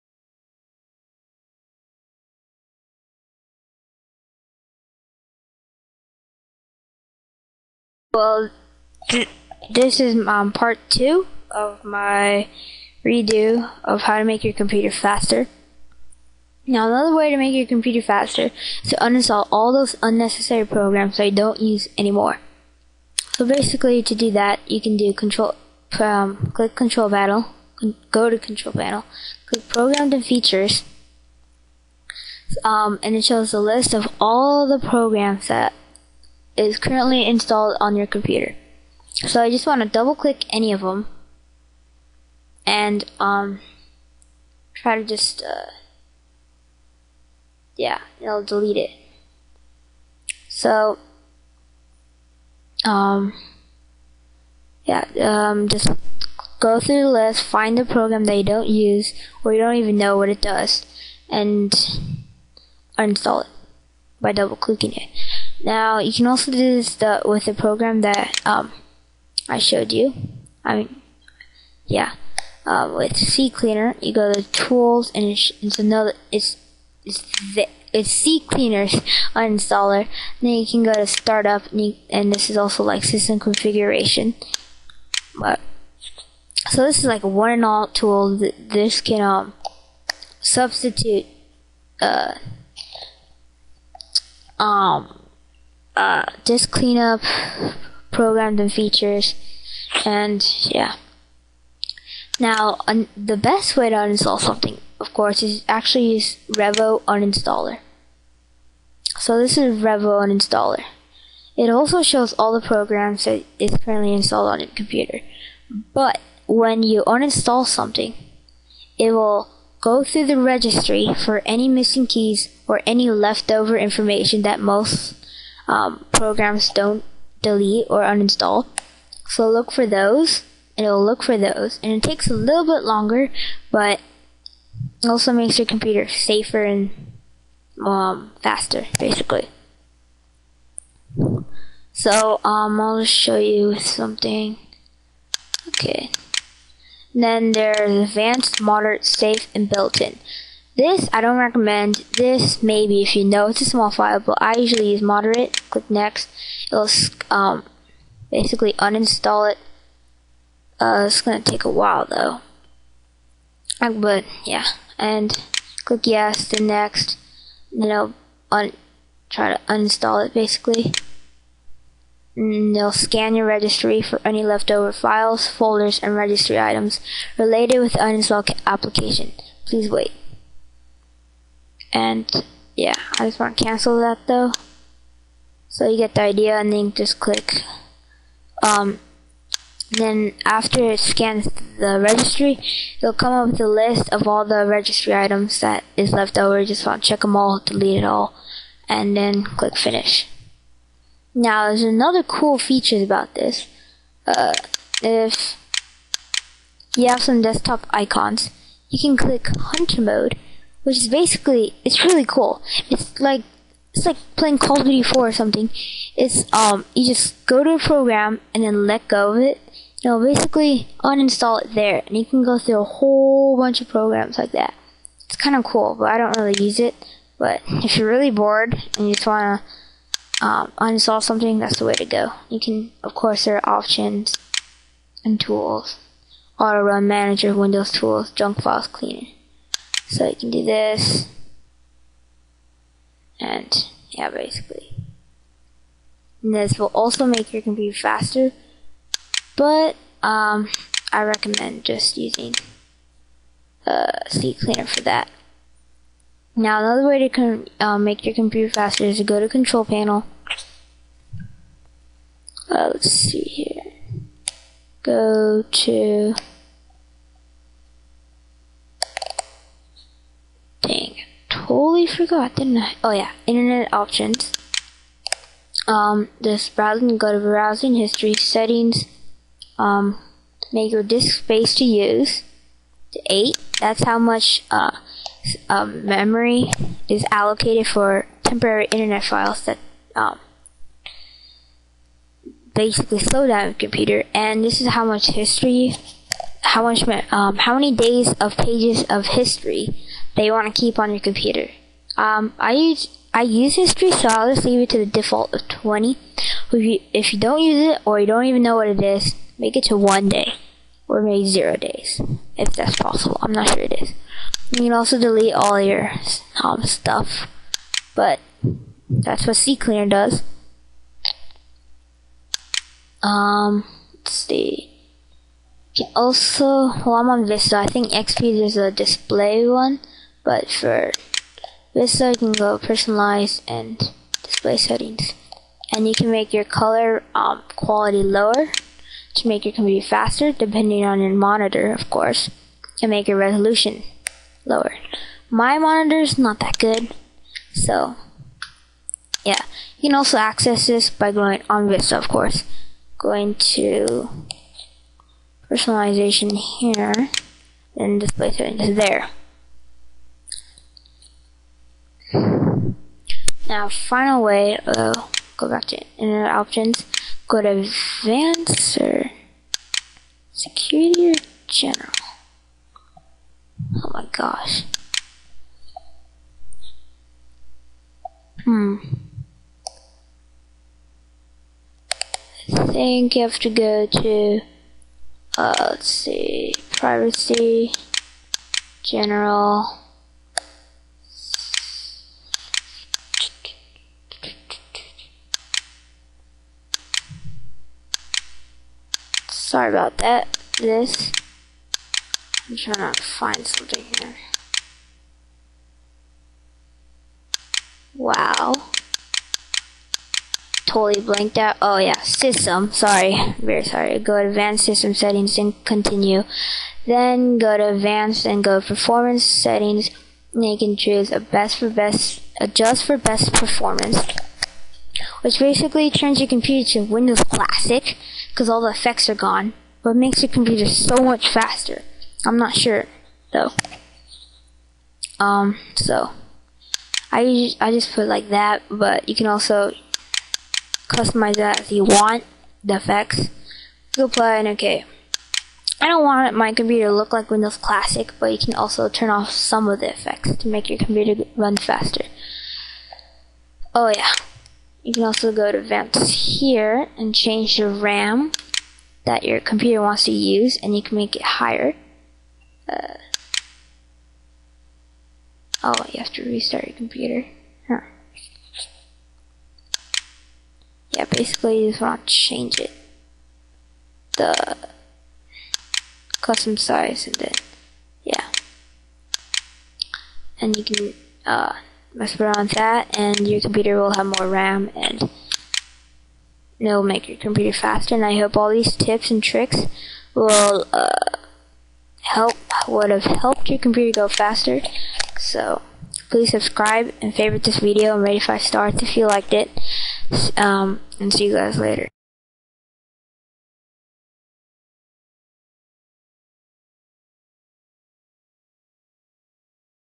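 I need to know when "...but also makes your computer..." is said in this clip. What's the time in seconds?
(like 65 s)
133 s.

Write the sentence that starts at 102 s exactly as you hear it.
Now, un- the best way to uninstall something, of course, is actually use Revo uninstaller.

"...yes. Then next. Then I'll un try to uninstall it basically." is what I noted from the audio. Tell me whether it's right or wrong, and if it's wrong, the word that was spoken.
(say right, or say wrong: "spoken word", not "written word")
right.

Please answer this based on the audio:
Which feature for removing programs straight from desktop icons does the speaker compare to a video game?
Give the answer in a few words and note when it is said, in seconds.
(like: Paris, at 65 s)
hunter mode, at 209 s.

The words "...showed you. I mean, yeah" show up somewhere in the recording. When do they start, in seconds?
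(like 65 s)
69 s.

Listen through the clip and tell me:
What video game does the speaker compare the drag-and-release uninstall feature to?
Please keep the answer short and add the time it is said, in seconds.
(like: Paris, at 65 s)
Call of Duty 4, at 214 s.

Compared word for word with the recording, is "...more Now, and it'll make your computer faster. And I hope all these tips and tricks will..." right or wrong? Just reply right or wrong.
wrong.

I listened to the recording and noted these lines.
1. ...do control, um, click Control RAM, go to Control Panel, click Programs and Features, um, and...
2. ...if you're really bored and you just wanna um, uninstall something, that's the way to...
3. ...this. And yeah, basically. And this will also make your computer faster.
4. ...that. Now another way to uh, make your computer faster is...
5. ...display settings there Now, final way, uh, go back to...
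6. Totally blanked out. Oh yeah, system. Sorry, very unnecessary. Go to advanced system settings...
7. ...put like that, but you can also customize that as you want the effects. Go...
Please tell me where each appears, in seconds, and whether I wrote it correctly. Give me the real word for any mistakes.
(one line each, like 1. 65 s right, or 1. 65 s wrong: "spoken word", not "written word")
1. 24 s wrong: "Panel", not "RAM"
2. 227 s right
3. 240 s right
4. 255 s right
5. 358 s right
6. 410 s wrong: "sorry", not "unnecessary"
7. 438 s right.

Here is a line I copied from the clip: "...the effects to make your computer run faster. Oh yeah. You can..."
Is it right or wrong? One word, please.
right.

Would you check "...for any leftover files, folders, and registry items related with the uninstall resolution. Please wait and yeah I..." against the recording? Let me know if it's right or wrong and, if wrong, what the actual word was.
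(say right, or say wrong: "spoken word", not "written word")
wrong: "application", not "resolution".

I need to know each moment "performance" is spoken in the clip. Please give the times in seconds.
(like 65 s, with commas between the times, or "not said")
418 s, 423 s.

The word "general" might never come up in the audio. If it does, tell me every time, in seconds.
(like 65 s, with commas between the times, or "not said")
371 s, 389 s.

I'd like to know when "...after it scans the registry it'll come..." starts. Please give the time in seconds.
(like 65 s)
190 s.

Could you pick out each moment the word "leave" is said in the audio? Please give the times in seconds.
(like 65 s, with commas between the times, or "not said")
304 s.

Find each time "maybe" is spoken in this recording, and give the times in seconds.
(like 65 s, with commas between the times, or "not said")
152 s, 311 s.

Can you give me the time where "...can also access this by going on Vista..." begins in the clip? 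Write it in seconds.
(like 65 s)
350 s.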